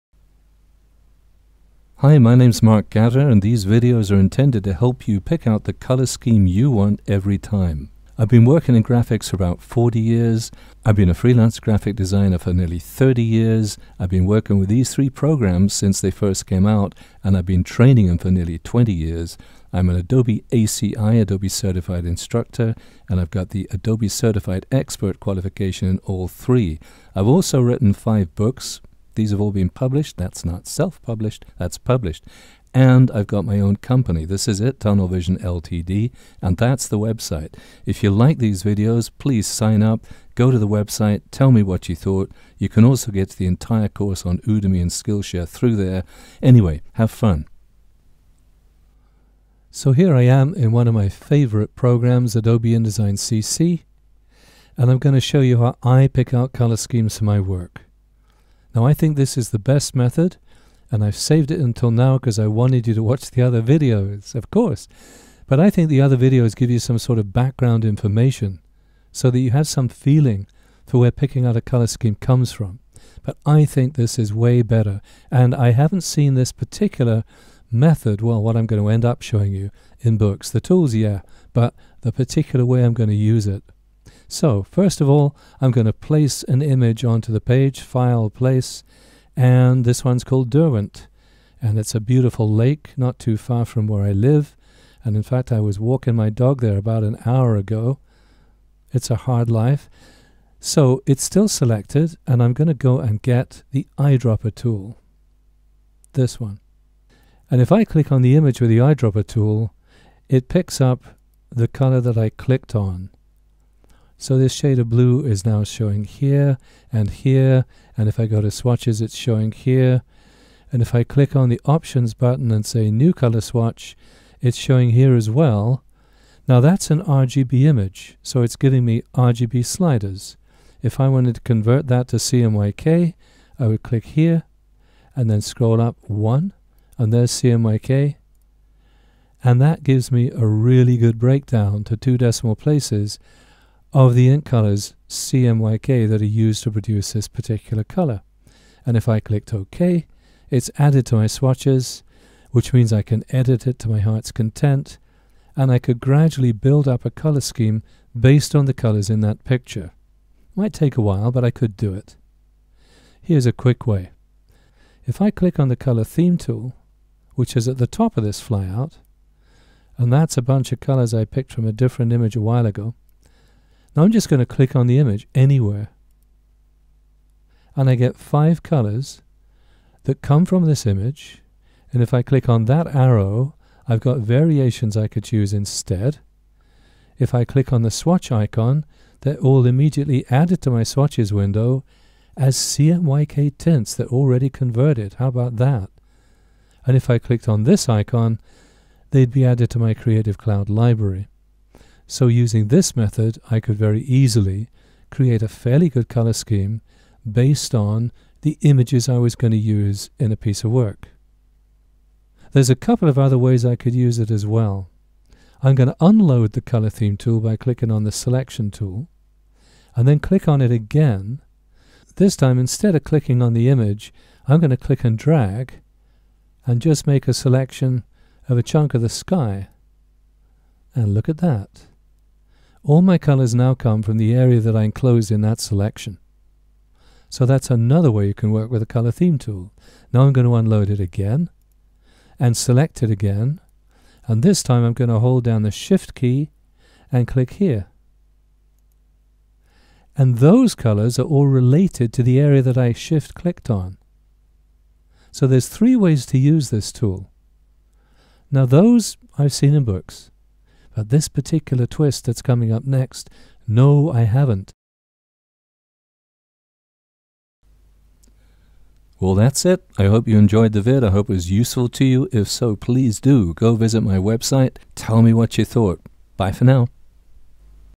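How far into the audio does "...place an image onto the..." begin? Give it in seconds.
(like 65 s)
85 s.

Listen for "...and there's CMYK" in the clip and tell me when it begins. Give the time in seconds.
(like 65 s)
136 s.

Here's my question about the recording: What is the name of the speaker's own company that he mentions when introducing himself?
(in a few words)
Tunnel Vision LTD.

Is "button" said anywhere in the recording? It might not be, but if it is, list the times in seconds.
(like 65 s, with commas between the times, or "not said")
122 s.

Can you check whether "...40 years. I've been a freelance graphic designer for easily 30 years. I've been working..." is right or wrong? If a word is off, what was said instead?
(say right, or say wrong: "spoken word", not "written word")
wrong: "nearly", not "easily".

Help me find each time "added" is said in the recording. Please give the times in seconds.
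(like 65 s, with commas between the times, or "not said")
150 s, 190 s, 199 s.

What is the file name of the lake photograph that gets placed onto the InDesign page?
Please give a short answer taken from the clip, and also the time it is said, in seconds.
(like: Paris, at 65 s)
Derwent, at 90 s.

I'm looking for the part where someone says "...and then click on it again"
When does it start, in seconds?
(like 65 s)
219 s.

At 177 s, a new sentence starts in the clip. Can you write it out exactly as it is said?
And I get five colors that come from this image.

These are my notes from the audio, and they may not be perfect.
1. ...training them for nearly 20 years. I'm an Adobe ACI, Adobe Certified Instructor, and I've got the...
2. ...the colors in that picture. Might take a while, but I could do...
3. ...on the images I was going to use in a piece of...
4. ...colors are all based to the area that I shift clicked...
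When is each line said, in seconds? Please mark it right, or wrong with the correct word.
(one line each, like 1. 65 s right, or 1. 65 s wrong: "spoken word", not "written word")
1. 17 s right
2. 158 s right
3. 207 s right
4. 250 s wrong: "related", not "based".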